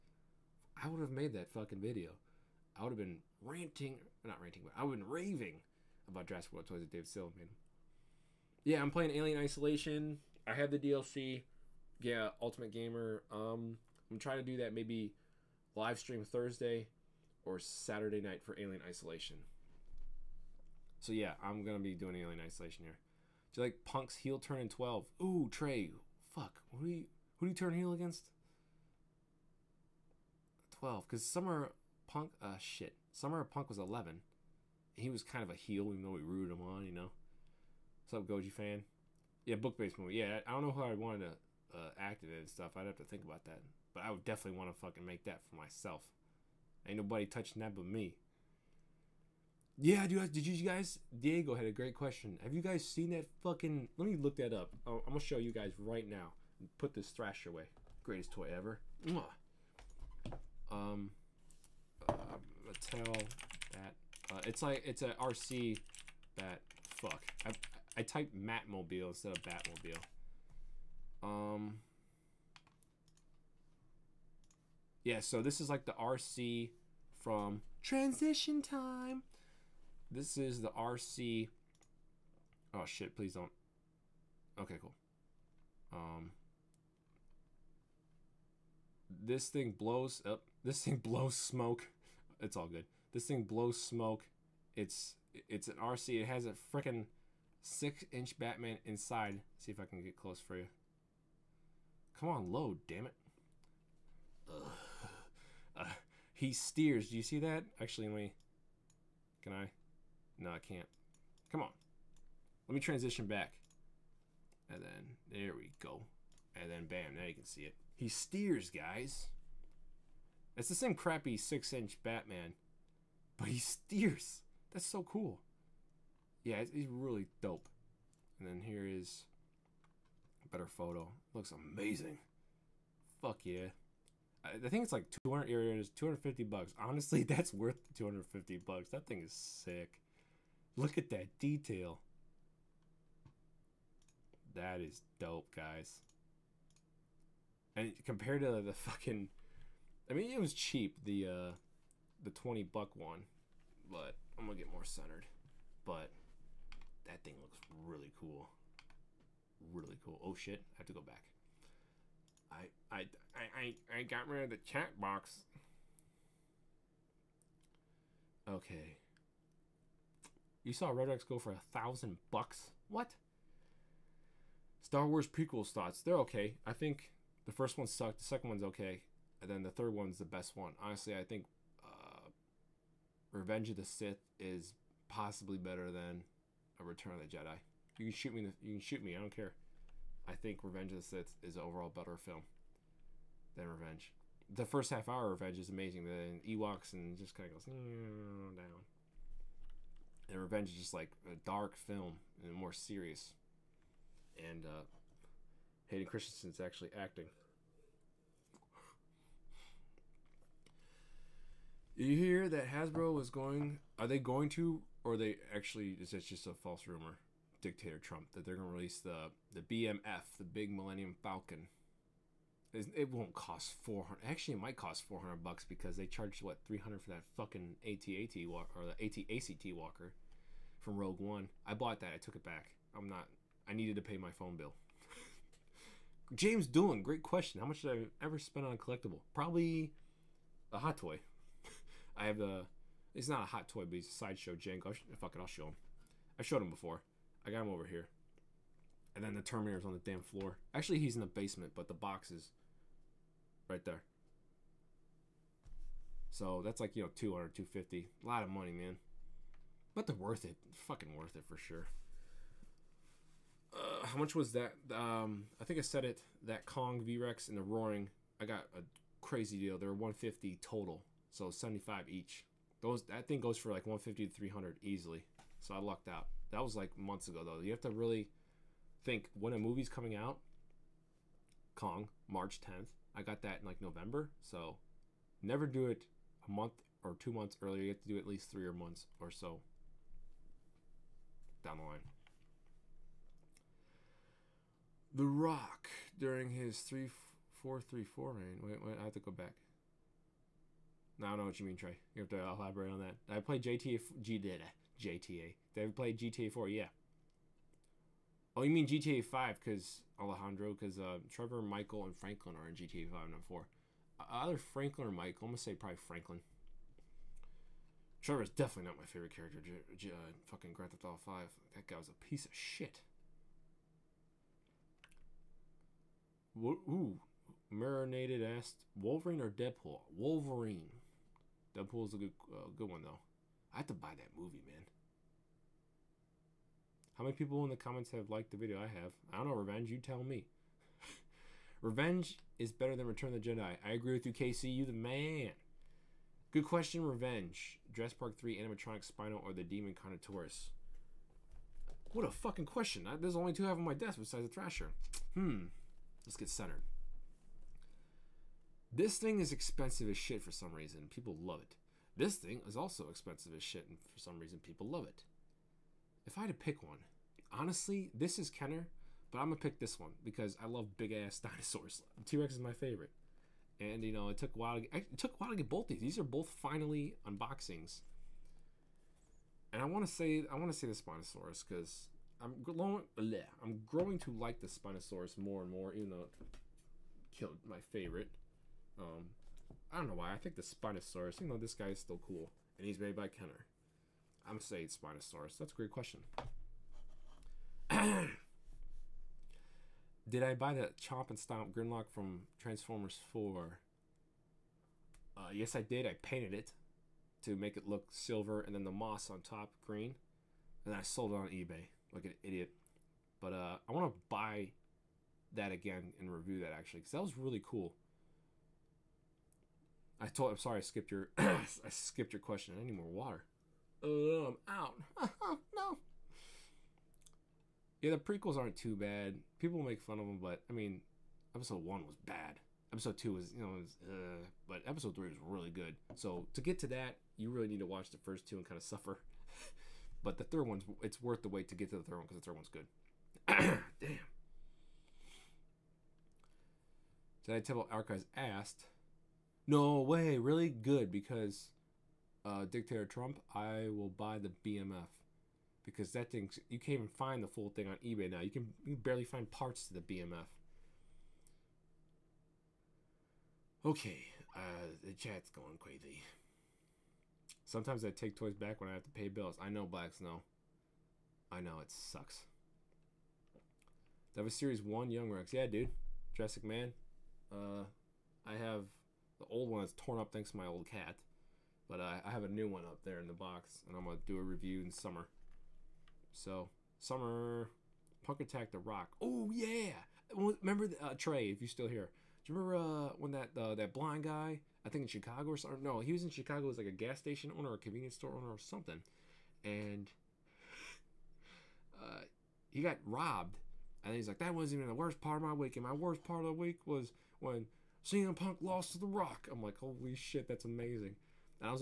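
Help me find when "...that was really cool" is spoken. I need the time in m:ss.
6:57.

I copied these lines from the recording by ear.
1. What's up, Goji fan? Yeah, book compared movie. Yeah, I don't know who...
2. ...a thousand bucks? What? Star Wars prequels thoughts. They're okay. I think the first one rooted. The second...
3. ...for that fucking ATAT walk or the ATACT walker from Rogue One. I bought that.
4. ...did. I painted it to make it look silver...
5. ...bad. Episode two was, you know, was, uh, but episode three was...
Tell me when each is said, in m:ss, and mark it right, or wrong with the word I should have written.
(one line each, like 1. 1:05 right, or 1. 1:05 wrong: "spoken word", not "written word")
1. 0:38 wrong: "based", not "compared"
2. 2:51 wrong: "sucked", not "rooted"
3. 3:47 right
4. 6:45 right
5. 7:12 right.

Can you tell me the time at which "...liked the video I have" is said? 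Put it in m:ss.
5:38.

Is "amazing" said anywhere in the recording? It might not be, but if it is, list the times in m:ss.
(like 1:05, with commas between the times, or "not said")
2:11, 3:15, 8:30.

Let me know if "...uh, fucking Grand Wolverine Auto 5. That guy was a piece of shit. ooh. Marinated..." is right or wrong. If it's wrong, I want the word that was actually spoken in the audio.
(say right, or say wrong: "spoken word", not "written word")
wrong: "Theft", not "Wolverine".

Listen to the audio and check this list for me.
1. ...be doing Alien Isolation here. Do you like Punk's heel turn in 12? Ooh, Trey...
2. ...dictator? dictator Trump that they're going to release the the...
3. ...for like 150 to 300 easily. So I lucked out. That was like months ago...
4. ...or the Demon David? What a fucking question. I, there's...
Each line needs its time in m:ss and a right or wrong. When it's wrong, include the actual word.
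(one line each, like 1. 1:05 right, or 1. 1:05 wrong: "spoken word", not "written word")
1. 0:21 right
2. 3:36 wrong: "rumor", not "dictator"
3. 4:33 right
4. 5:49 wrong: "Connoisseurs", not "David".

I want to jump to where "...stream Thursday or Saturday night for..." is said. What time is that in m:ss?
0:15.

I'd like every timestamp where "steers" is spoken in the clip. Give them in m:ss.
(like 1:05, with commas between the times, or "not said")
1:46, 1:58, 2:03.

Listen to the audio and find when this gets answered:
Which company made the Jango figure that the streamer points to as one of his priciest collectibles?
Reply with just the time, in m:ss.
4:04.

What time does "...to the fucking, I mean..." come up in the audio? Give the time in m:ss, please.
2:28.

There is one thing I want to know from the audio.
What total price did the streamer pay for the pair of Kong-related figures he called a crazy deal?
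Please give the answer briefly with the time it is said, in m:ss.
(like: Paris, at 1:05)
$150, at 4:29.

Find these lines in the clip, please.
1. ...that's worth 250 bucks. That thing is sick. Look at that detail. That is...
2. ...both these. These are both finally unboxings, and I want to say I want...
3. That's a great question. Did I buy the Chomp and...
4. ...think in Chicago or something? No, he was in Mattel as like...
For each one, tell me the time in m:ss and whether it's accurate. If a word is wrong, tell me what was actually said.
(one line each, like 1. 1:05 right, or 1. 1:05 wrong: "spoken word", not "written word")
1. 2:17 right
2. 6:15 right
3. 6:35 right
4. 8:14 wrong: "Chicago", not "Mattel".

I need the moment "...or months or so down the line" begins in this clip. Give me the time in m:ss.
4:48.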